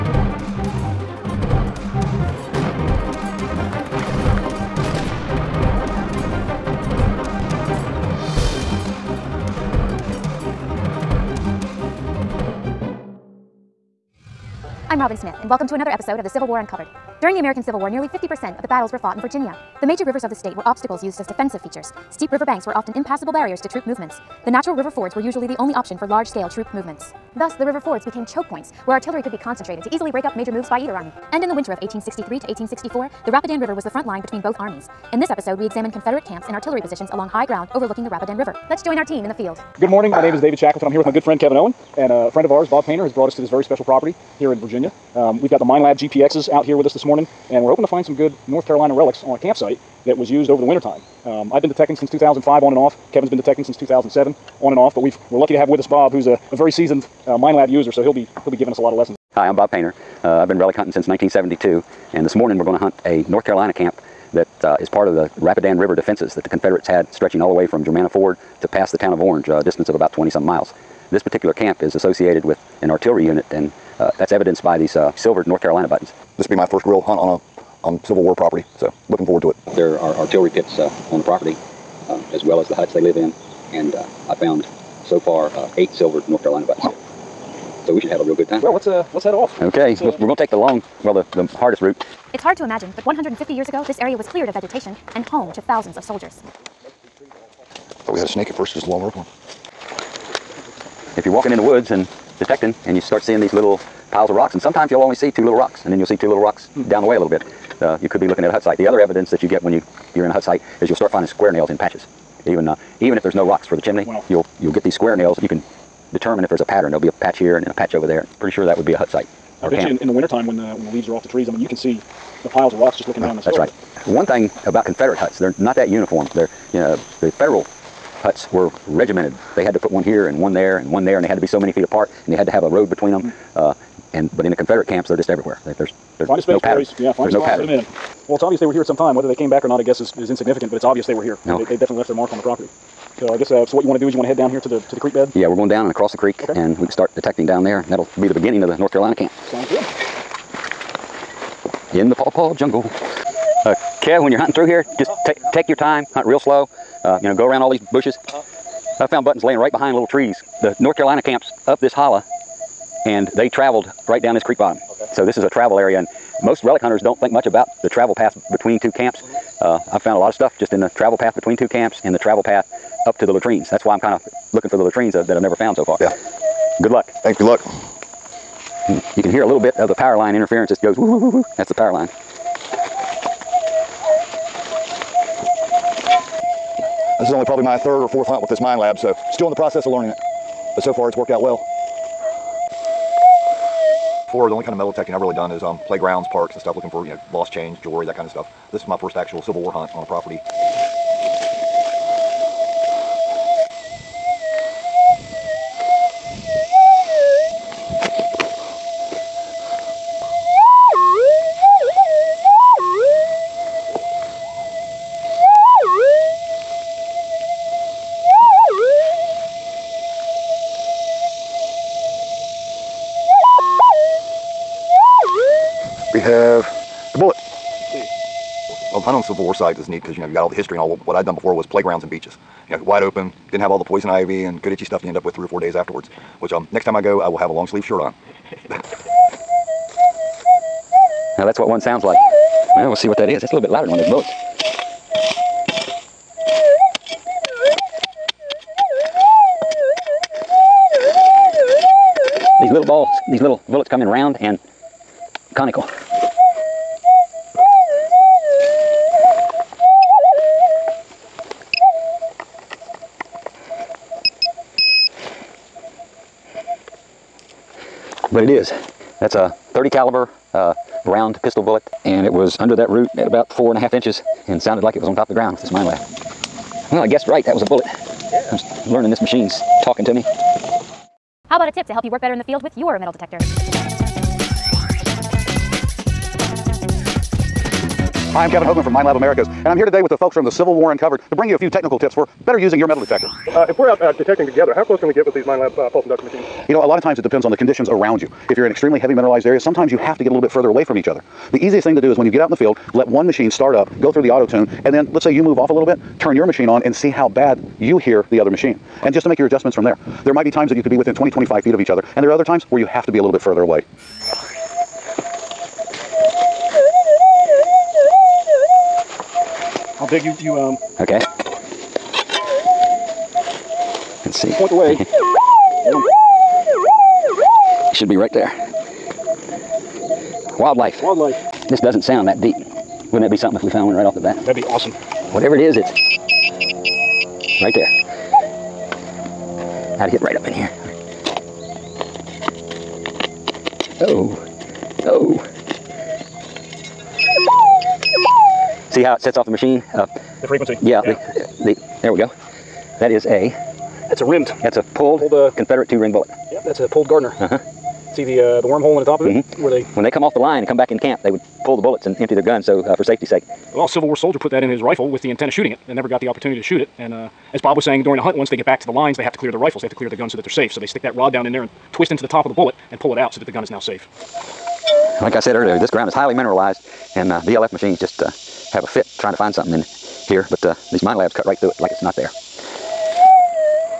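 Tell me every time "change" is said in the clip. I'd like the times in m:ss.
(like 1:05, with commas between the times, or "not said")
3:17.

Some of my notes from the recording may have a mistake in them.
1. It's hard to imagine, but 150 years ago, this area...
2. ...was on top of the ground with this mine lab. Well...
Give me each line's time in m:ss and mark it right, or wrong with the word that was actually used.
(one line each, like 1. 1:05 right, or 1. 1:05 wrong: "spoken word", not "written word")
1. 1:32 right
2. 4:35 right.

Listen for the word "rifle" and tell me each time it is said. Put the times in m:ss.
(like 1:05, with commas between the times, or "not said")
6:04, 6:09.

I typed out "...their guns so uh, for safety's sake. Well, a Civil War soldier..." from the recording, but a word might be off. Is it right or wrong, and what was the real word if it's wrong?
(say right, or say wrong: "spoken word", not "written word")
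right.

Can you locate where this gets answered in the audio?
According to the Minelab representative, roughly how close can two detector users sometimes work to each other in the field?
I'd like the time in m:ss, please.
5:11.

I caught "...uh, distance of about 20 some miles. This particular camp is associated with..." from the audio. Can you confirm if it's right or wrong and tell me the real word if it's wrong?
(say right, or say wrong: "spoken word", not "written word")
right.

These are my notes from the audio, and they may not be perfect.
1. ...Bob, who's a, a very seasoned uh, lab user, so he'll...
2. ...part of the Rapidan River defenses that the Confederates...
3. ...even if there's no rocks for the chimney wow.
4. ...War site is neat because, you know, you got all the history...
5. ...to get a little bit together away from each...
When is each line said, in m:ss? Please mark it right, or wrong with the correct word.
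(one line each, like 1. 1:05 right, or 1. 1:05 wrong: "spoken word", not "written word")
1. 0:55 right
2. 1:04 right
3. 1:53 right
4. 3:49 right
5. 5:00 wrong: "further", not "together".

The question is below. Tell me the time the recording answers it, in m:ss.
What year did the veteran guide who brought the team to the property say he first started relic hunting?
1:01.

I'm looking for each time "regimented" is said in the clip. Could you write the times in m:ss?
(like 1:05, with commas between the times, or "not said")
2:08.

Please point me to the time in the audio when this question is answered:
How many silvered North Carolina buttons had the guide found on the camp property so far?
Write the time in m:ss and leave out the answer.
1:25.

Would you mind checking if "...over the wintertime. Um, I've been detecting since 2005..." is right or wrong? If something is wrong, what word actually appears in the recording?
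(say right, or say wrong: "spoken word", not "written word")
right.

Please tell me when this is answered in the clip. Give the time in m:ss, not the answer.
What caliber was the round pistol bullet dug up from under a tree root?
4:29.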